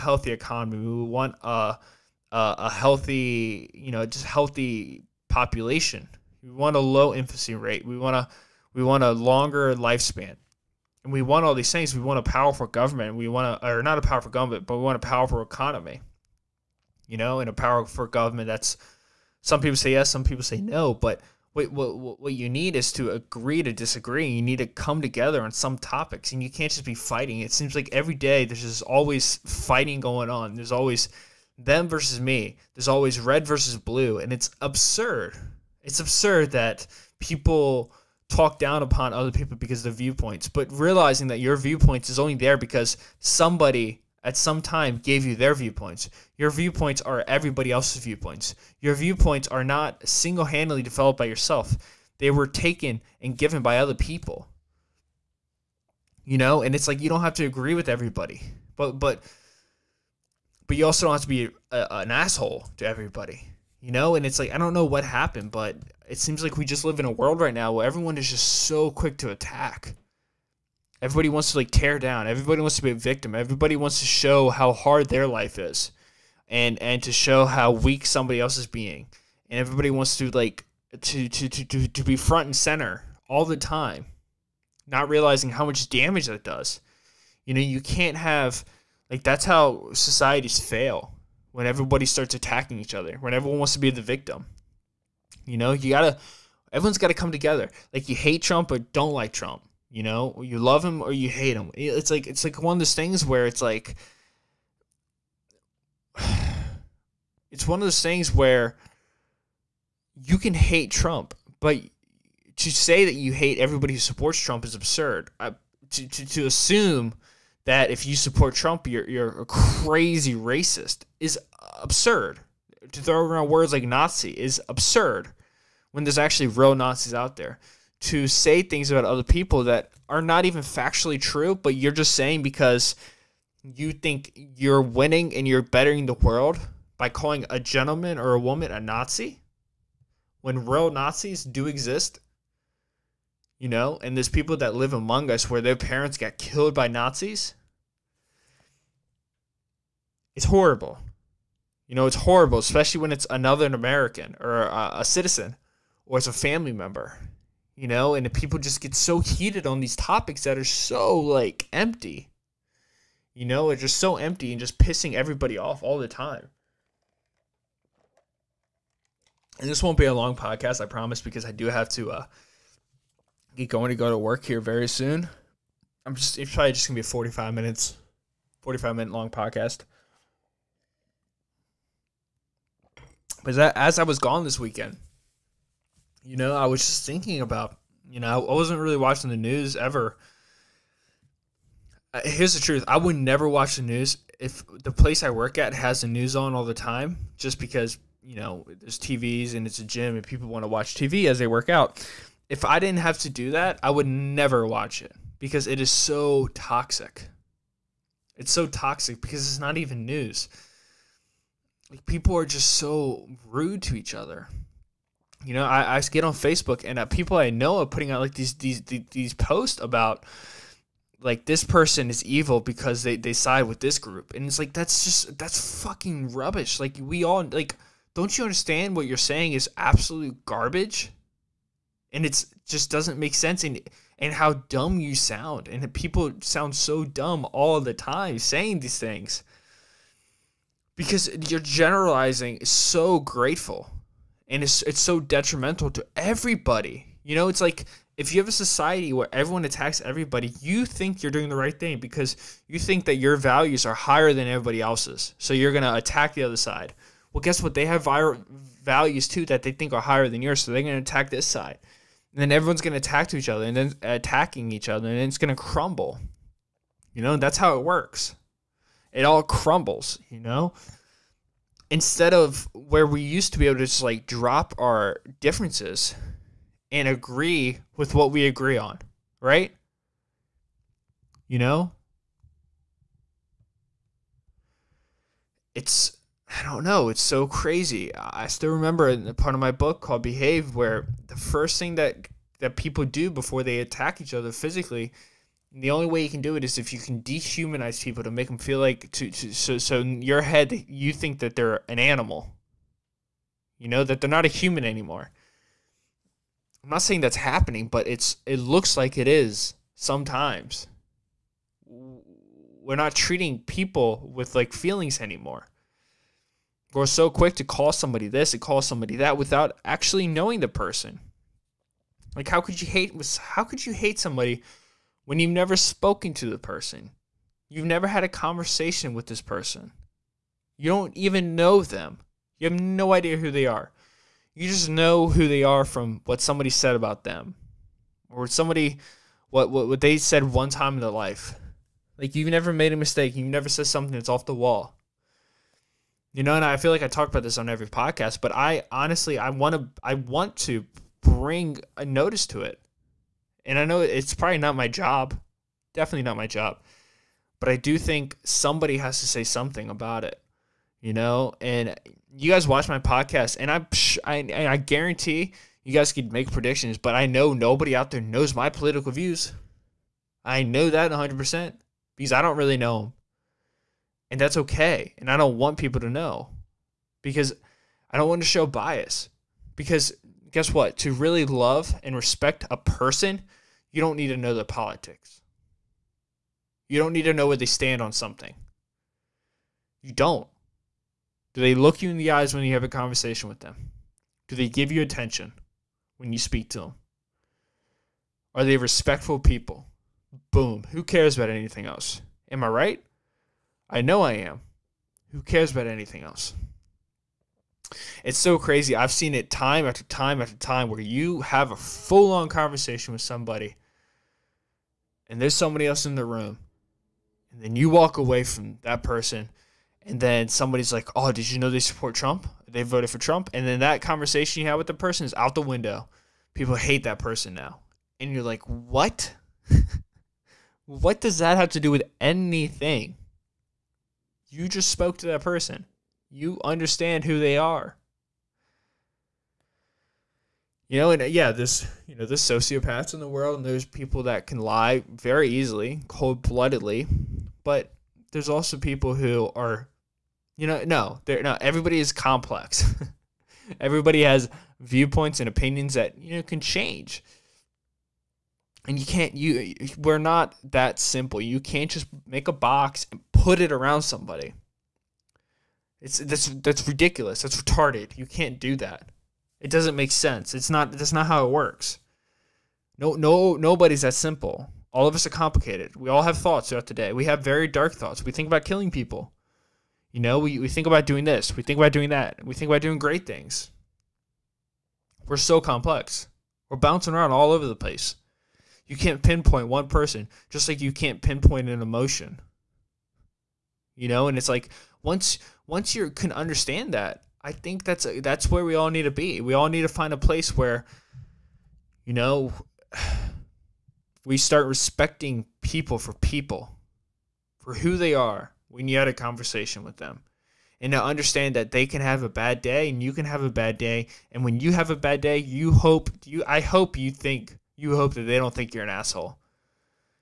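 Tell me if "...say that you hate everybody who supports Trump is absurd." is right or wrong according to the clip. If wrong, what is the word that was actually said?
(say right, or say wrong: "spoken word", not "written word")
right.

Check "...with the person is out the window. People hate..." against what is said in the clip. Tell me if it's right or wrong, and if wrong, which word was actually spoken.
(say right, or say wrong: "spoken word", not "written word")
right.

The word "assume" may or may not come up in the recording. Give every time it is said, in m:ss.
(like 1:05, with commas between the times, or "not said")
1:56.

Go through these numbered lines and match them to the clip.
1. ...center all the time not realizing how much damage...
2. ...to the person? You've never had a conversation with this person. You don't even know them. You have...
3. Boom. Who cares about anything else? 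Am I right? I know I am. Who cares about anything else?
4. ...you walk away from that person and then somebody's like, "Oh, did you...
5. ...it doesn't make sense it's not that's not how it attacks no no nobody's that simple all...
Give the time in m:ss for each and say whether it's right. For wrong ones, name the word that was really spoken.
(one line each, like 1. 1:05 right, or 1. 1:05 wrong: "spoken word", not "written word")
1. 1:22 right
2. 5:26 right
3. 6:40 right
4. 6:57 right
5. 7:49 wrong: "works", not "attacks".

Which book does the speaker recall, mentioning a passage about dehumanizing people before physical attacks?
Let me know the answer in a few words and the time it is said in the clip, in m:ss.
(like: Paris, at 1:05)
Behave, at 4:50.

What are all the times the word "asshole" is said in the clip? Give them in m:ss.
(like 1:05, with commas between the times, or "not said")
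1:02, 8:38.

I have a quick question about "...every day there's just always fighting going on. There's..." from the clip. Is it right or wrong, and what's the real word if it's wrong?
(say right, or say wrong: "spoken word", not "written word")
right.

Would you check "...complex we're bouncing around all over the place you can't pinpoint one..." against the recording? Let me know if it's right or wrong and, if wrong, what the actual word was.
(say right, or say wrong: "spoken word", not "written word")
right.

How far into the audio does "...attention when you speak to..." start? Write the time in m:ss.
6:35.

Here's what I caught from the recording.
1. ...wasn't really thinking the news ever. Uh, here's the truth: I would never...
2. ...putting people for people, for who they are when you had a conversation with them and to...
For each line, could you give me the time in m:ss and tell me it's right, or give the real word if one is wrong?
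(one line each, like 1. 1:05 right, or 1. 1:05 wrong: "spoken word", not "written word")
1. 3:08 wrong: "watching", not "thinking"
2. 8:24 wrong: "respecting", not "putting".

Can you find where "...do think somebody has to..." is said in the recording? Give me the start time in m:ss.
5:57.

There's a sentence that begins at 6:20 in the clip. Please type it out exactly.
To really love and respect a person, you don't need to know their politics.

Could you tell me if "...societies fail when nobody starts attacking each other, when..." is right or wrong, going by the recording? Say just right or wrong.
wrong.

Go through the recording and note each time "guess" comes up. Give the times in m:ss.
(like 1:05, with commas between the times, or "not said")
4:17, 6:20.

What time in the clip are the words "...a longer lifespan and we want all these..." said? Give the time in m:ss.
0:09.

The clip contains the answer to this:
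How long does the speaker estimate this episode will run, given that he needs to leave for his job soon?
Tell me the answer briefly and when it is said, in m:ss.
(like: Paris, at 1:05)
45 minutes, at 2:58.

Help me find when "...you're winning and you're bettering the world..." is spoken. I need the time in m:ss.
2:14.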